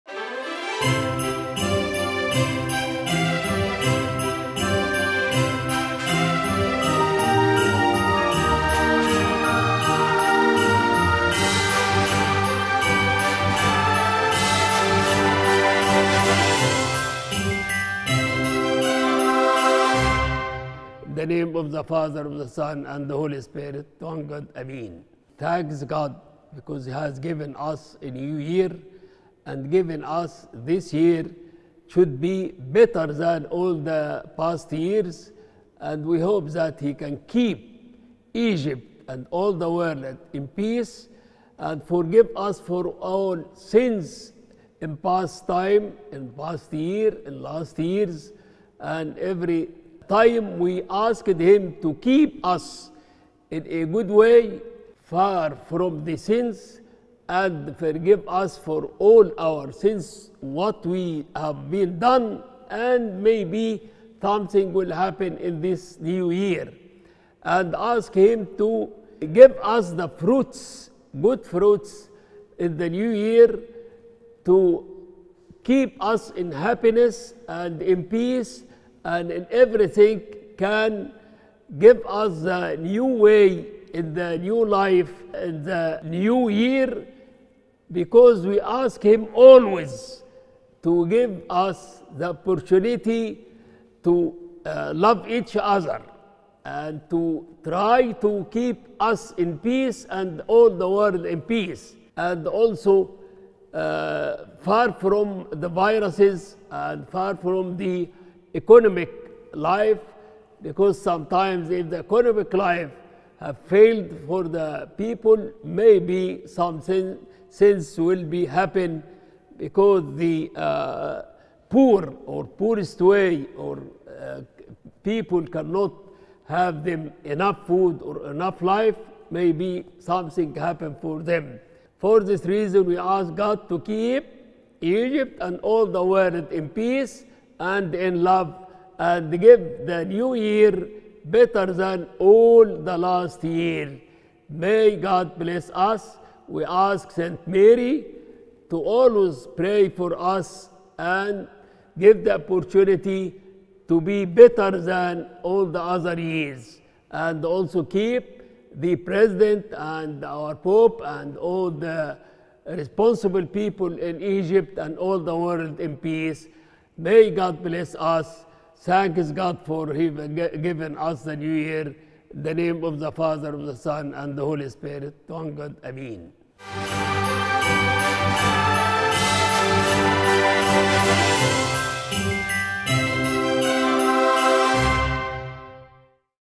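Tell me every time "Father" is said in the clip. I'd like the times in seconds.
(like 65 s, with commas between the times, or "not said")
21 s, 173 s.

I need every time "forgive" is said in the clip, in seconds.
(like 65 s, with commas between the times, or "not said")
41 s, 57 s.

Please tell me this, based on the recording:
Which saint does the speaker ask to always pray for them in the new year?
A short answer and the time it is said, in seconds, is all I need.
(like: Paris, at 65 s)
Saint Mary, at 147 s.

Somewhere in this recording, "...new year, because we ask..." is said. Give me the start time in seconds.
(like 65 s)
86 s.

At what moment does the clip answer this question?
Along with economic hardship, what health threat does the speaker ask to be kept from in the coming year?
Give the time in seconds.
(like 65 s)
105 s.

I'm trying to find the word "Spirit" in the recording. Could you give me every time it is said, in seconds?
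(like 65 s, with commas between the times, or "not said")
23 s, 174 s.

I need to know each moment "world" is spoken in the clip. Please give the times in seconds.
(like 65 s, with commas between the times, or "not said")
39 s, 100 s, 136 s, 165 s.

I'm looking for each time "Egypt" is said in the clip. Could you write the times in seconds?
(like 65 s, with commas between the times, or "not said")
38 s, 134 s, 164 s.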